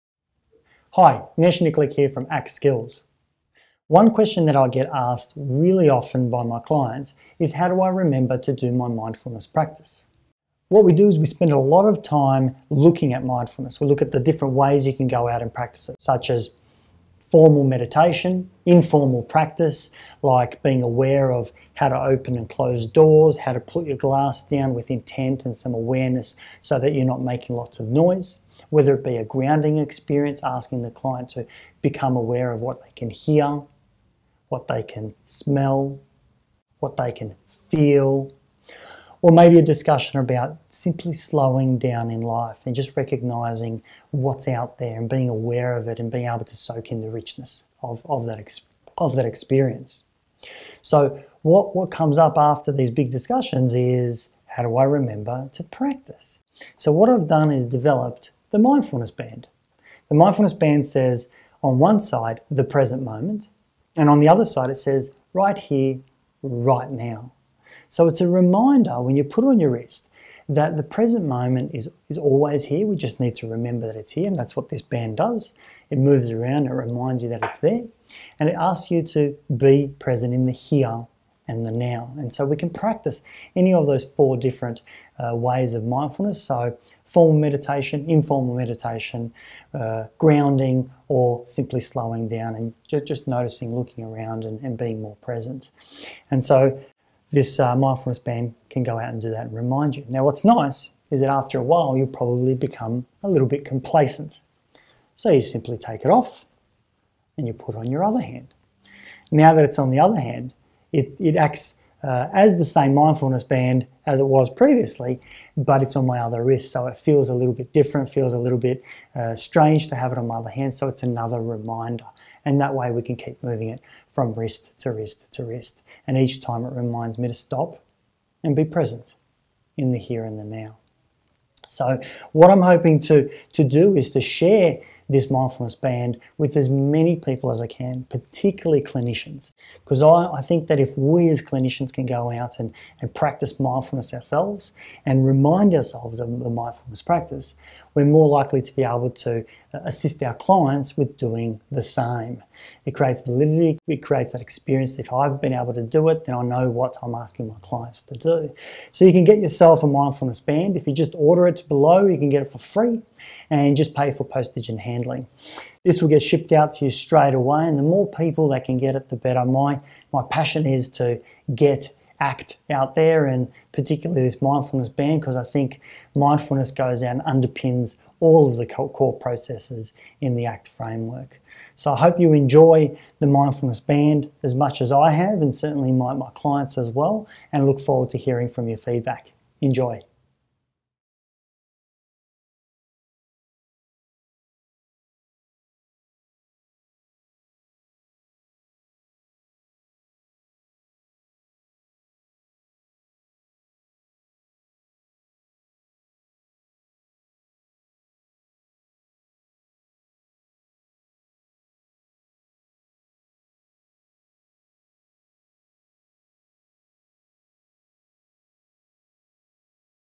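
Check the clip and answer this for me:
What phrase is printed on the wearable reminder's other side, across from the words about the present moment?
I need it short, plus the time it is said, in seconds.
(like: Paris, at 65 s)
right here, right now, at 65 s.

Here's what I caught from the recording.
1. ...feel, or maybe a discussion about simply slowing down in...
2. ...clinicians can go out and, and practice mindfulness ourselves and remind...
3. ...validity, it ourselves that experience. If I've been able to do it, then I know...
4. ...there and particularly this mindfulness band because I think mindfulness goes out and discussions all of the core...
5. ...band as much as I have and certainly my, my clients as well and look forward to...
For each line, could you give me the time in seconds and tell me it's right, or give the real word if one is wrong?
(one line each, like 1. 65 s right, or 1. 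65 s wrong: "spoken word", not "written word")
1. 37 s right
2. 141 s right
3. 153 s wrong: "creates", not "ourselves"
4. 172 s wrong: "underpins", not "discussions"
5. 183 s right.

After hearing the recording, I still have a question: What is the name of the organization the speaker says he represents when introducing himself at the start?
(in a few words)
ACT Skills.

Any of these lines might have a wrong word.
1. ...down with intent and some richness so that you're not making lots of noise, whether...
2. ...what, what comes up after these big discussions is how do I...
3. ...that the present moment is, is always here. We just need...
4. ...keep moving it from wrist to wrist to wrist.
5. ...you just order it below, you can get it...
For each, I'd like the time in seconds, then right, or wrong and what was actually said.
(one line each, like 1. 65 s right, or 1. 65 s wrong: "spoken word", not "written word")
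1. 24 s wrong: "awareness", not "richness"
2. 51 s right
3. 70 s right
4. 123 s right
5. 160 s right.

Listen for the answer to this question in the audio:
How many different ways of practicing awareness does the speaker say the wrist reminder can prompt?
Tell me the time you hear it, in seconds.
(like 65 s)
84 s.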